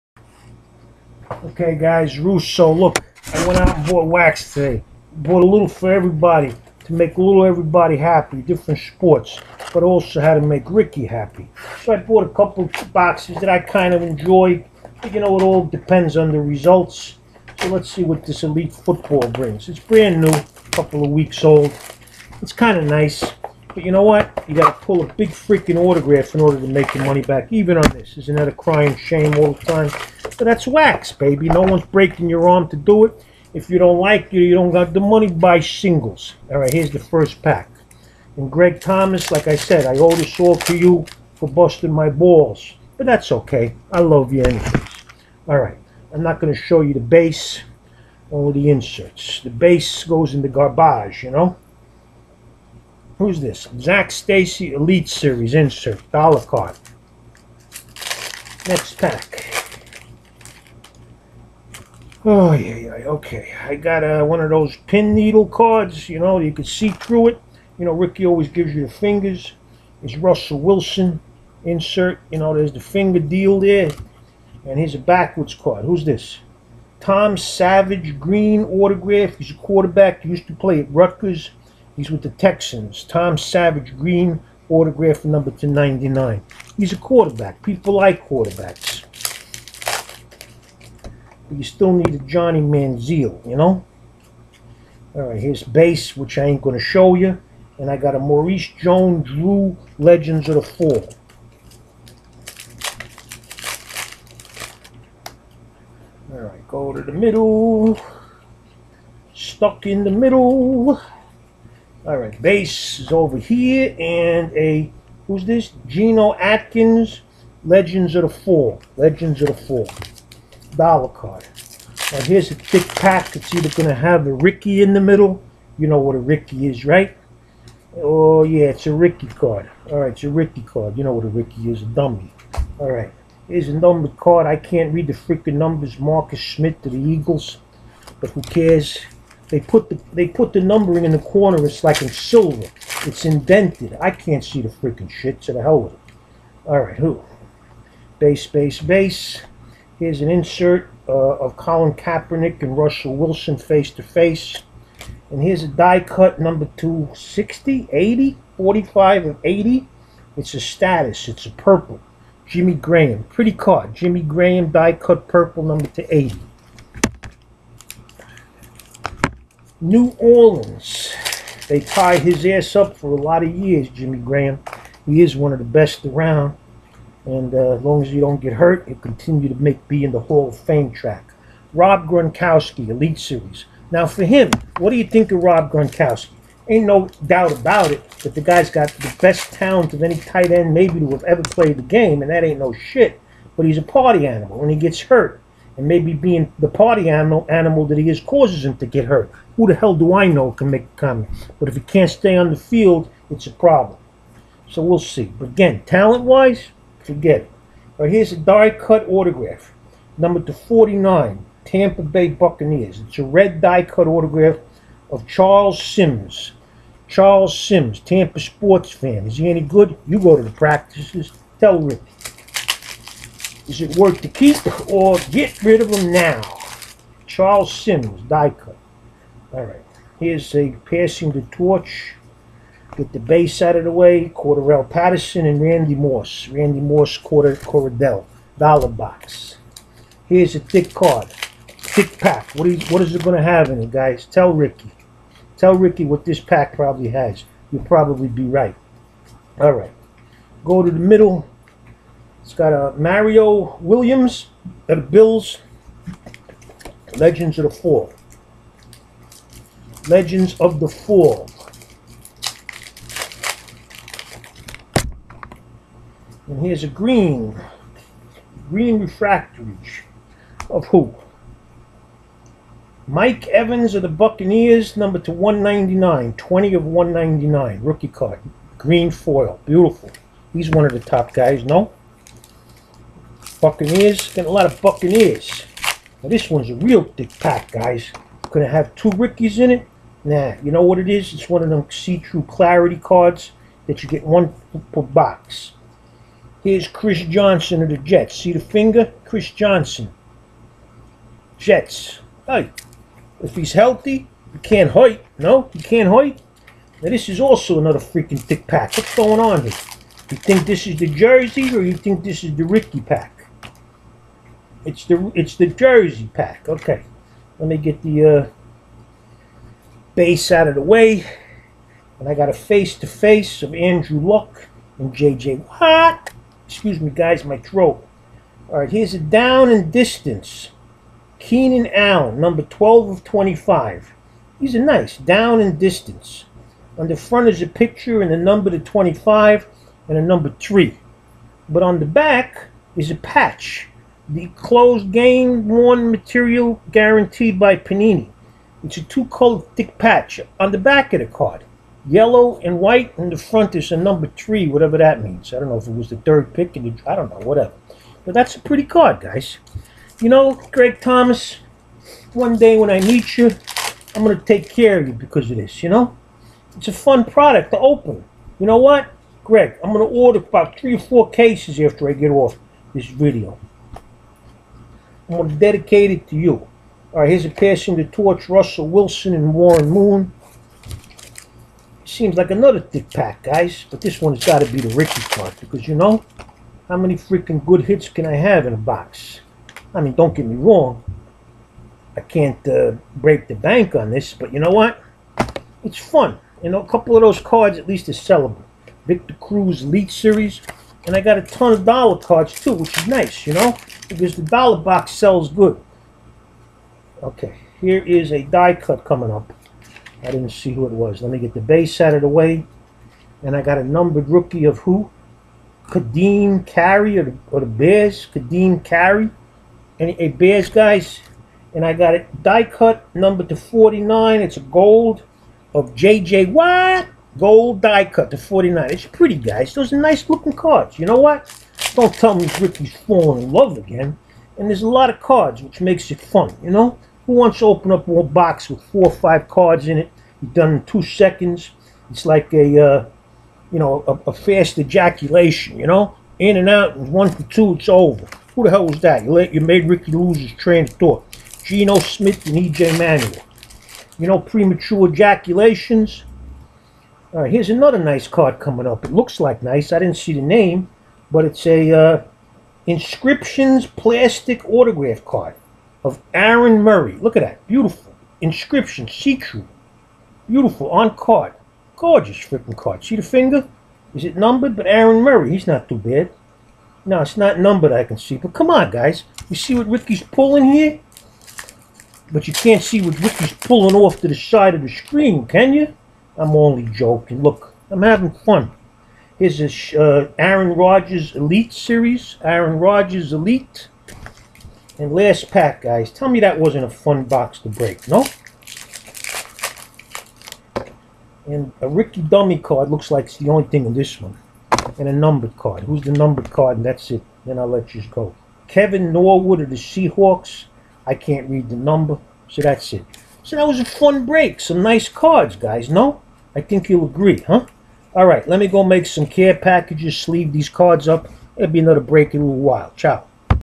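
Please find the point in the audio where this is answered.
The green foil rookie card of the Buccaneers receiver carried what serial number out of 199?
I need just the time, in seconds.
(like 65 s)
276 s.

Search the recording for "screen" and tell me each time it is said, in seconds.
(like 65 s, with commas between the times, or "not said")
484 s.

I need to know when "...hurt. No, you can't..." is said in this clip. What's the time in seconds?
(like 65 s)
304 s.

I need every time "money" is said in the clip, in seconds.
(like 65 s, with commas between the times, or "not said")
27 s, 34 s.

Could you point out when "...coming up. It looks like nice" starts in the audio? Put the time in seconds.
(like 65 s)
458 s.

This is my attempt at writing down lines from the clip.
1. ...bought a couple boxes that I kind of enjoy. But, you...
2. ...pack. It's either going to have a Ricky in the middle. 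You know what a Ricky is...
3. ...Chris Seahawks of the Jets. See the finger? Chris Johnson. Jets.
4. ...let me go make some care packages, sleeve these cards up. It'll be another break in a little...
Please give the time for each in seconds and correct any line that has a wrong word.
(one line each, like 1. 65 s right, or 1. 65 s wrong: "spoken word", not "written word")
1. 11 s right
2. 122 s right
3. 296 s wrong: "Johnson", not "Seahawks"
4. 518 s right.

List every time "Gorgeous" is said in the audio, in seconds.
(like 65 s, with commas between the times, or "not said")
471 s.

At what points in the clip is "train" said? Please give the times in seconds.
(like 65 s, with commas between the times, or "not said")
450 s.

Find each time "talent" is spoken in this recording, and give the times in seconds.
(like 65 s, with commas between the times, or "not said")
189 s, 205 s.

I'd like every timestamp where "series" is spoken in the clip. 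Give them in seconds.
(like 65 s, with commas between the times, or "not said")
55 s, 183 s, 400 s, 491 s.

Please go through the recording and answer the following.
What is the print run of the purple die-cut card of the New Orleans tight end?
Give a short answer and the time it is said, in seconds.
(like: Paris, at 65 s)
80, at 165 s.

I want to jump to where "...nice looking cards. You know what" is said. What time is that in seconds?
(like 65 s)
429 s.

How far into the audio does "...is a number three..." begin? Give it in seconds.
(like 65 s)
353 s.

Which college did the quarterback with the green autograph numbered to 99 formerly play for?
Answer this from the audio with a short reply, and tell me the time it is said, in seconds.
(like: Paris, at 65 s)
Rutgers, at 80 s.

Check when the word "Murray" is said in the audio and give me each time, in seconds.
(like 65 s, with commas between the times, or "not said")
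466 s, 475 s.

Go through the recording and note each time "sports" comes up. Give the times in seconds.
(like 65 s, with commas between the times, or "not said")
8 s, 218 s.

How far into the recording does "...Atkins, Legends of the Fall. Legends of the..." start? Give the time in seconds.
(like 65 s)
116 s.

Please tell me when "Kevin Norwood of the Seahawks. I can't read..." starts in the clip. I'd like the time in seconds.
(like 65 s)
508 s.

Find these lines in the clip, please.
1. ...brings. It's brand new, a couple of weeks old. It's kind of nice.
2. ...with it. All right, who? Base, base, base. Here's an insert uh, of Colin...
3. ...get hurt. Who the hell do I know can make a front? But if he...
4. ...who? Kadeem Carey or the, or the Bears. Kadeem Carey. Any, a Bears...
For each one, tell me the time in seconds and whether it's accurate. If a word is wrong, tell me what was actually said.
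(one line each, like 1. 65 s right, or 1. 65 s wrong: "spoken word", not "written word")
1. 19 s right
2. 145 s right
3. 198 s wrong: "comment", not "front"
4. 414 s right.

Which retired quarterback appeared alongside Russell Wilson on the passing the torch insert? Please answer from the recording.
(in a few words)
Warren Moon.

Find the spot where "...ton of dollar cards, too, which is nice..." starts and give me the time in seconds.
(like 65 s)
401 s.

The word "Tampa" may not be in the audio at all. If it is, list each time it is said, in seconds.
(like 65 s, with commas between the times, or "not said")
211 s, 217 s.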